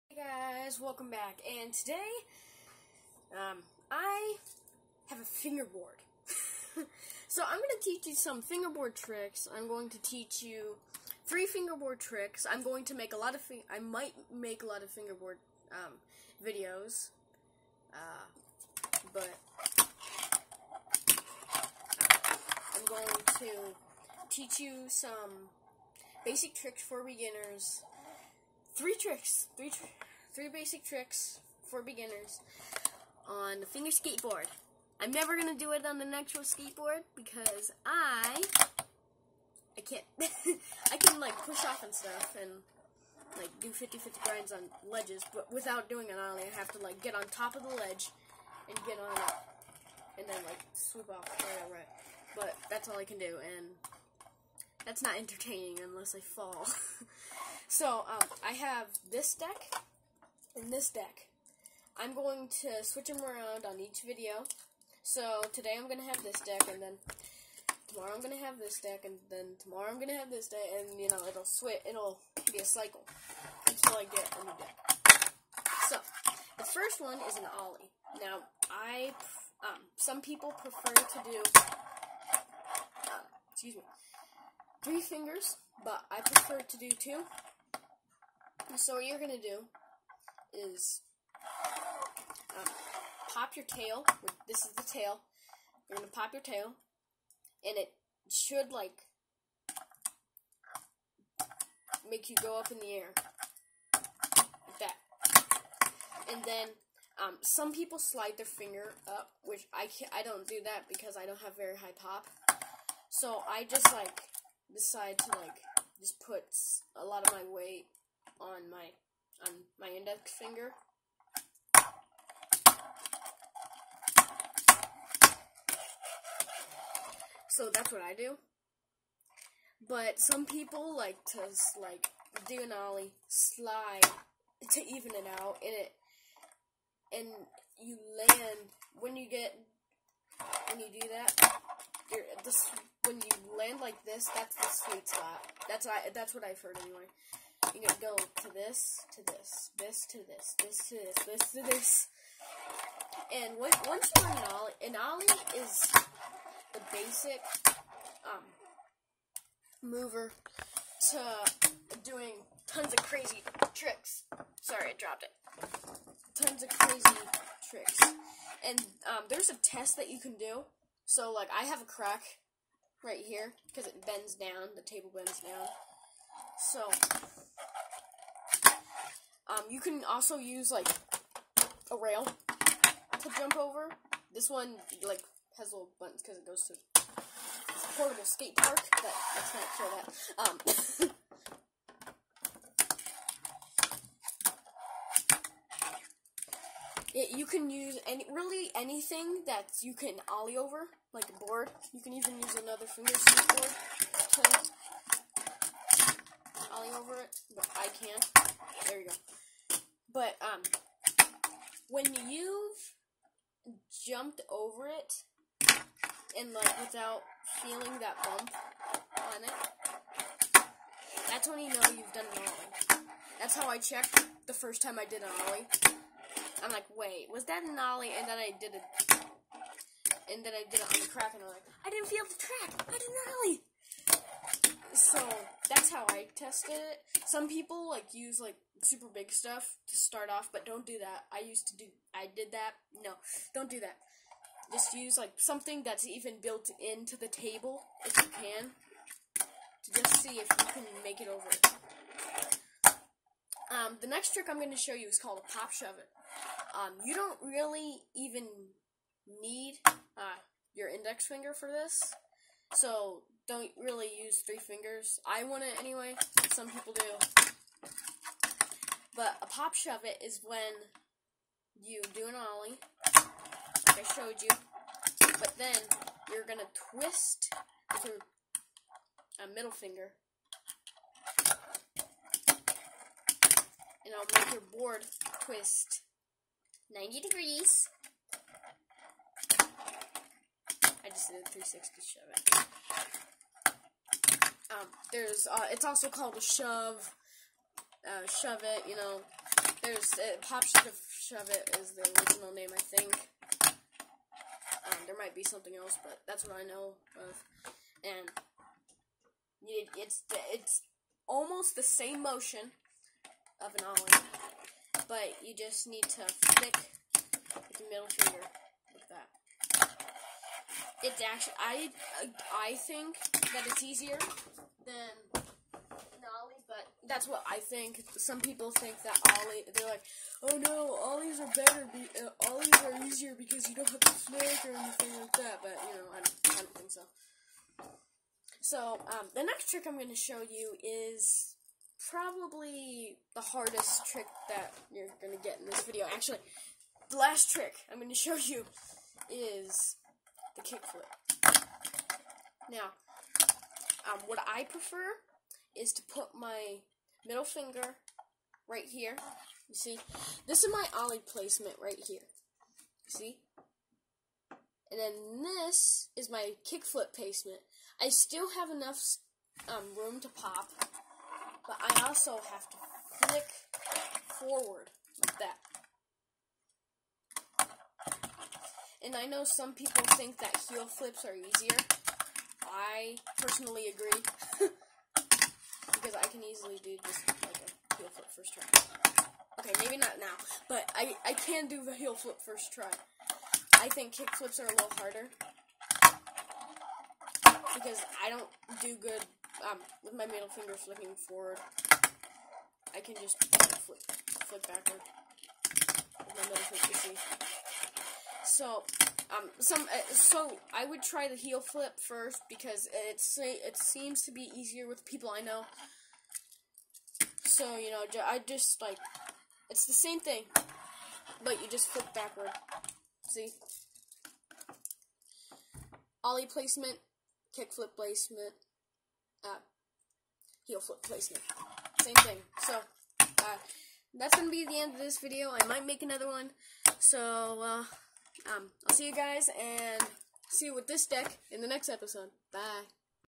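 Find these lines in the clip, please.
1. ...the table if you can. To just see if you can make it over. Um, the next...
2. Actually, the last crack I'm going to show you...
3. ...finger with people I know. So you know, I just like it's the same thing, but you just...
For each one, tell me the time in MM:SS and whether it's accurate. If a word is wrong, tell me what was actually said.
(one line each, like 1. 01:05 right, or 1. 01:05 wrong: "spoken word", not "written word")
1. 04:07 right
2. 05:46 wrong: "trick", not "crack"
3. 06:54 wrong: "easier", not "finger".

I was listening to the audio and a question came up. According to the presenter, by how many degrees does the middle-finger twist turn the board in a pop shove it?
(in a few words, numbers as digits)
90 degrees.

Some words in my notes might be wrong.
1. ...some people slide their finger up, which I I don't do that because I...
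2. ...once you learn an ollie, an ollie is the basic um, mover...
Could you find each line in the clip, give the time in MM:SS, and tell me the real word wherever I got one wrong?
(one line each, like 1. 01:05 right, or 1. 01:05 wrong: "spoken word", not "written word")
1. 01:47 right
2. 02:33 right.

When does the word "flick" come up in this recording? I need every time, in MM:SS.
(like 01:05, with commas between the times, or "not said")
05:16, 06:13.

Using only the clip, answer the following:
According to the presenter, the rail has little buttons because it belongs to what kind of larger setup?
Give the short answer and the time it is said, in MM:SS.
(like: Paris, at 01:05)
Portable skate park, at 03:07.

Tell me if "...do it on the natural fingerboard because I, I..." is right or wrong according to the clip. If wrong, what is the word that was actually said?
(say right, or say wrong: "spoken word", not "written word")
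wrong: "skateboard", not "fingerboard".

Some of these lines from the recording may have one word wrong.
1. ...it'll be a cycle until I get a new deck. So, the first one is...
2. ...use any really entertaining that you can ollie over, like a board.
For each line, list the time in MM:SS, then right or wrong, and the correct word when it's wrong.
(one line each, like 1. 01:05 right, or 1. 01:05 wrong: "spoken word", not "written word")
1. 01:11 right
2. 03:17 wrong: "anything", not "entertaining".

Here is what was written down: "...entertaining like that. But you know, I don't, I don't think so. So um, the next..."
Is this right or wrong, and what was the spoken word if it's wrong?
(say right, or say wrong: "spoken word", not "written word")
wrong: "anything", not "entertaining".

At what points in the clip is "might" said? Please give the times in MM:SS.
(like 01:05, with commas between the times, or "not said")
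00:13, 05:05, 07:15.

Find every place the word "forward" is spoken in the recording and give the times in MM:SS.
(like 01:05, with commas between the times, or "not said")
06:14, 06:41.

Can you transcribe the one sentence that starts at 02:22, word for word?
This, when you land like this, that's the sweet spot.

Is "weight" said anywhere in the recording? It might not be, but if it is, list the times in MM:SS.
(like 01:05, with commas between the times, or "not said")
01:57.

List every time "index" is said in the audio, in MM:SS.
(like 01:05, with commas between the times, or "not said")
01:59, 04:20.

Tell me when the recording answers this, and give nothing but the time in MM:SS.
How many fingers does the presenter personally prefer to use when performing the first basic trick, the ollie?
01:26.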